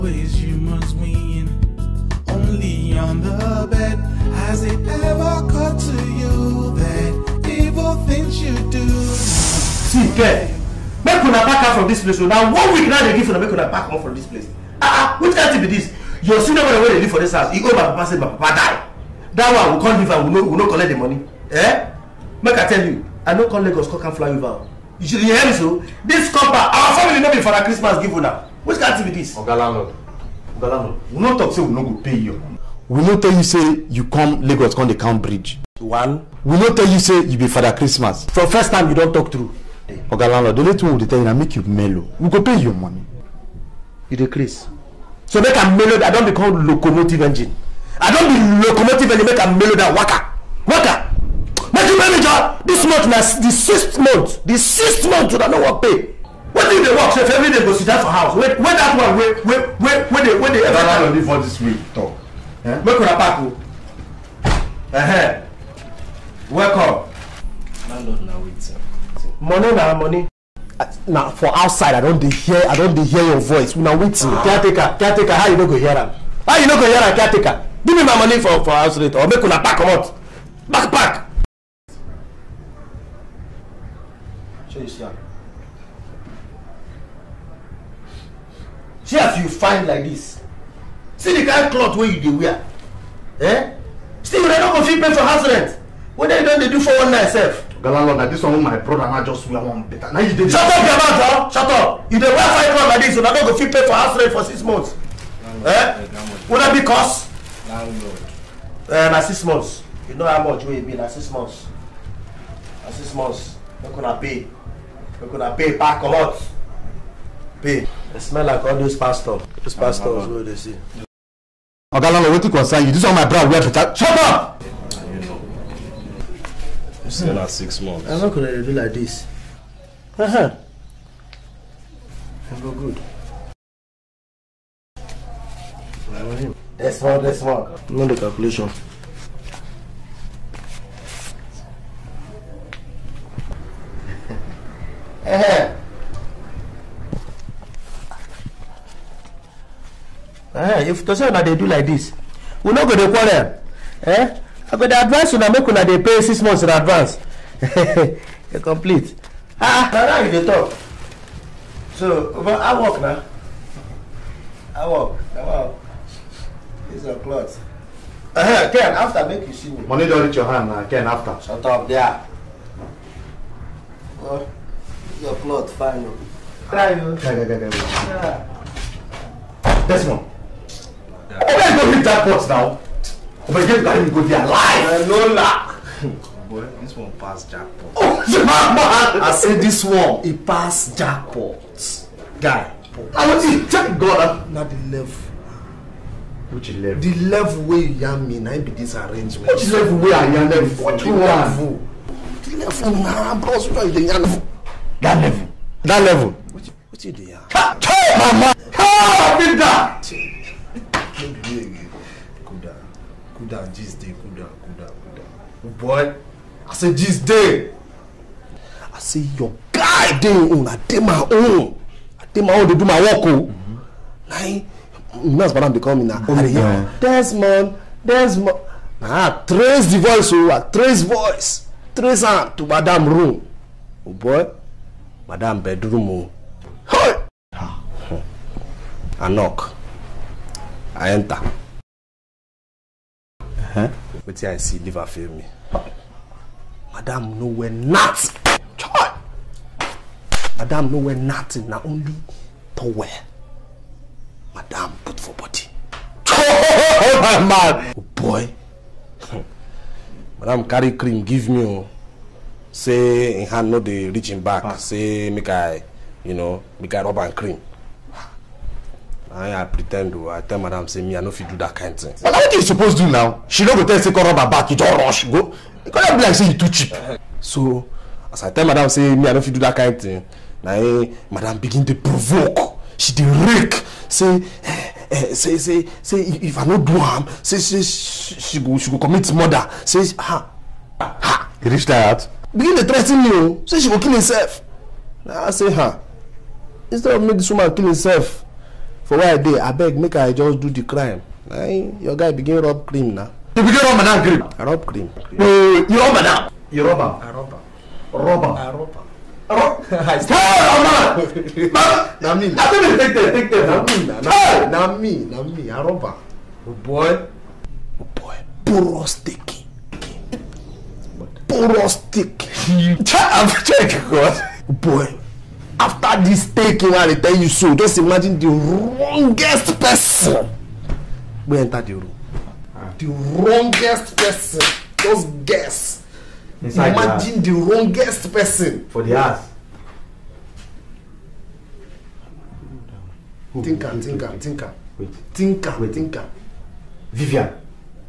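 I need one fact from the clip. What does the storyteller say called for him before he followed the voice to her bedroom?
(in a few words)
Nurse madam.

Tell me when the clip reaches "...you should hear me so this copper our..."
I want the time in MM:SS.
00:24.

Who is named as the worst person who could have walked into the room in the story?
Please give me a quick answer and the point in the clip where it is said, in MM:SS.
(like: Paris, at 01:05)
Vivian, at 05:47.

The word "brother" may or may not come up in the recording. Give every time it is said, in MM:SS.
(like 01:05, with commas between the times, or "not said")
00:16, 01:38, 02:03.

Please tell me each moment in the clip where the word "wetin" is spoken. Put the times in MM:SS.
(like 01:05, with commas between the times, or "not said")
01:13, 04:04, 04:32.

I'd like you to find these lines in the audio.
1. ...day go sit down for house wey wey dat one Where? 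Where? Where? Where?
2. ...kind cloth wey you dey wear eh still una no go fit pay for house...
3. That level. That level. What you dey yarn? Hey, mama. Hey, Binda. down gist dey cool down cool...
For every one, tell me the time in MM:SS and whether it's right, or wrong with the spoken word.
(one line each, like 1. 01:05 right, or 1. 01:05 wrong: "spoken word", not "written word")
1. 00:57 right
2. 01:31 right
3. 03:25 right.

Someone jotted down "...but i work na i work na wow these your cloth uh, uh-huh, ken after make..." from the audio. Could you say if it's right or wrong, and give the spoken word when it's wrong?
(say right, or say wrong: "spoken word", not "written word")
right.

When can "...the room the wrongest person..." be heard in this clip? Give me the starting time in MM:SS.
05:31.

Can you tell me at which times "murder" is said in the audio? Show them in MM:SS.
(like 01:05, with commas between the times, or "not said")
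04:49.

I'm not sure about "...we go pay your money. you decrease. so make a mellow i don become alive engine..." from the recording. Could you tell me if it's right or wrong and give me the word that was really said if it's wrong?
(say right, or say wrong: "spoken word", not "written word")
wrong: "locomotive", not "alive".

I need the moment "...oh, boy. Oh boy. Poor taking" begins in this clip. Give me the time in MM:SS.
05:16.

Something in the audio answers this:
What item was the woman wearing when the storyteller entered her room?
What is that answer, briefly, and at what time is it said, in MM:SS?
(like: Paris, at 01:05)
Towel, at 04:12.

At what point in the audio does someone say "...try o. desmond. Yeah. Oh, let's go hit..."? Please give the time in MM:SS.
02:56.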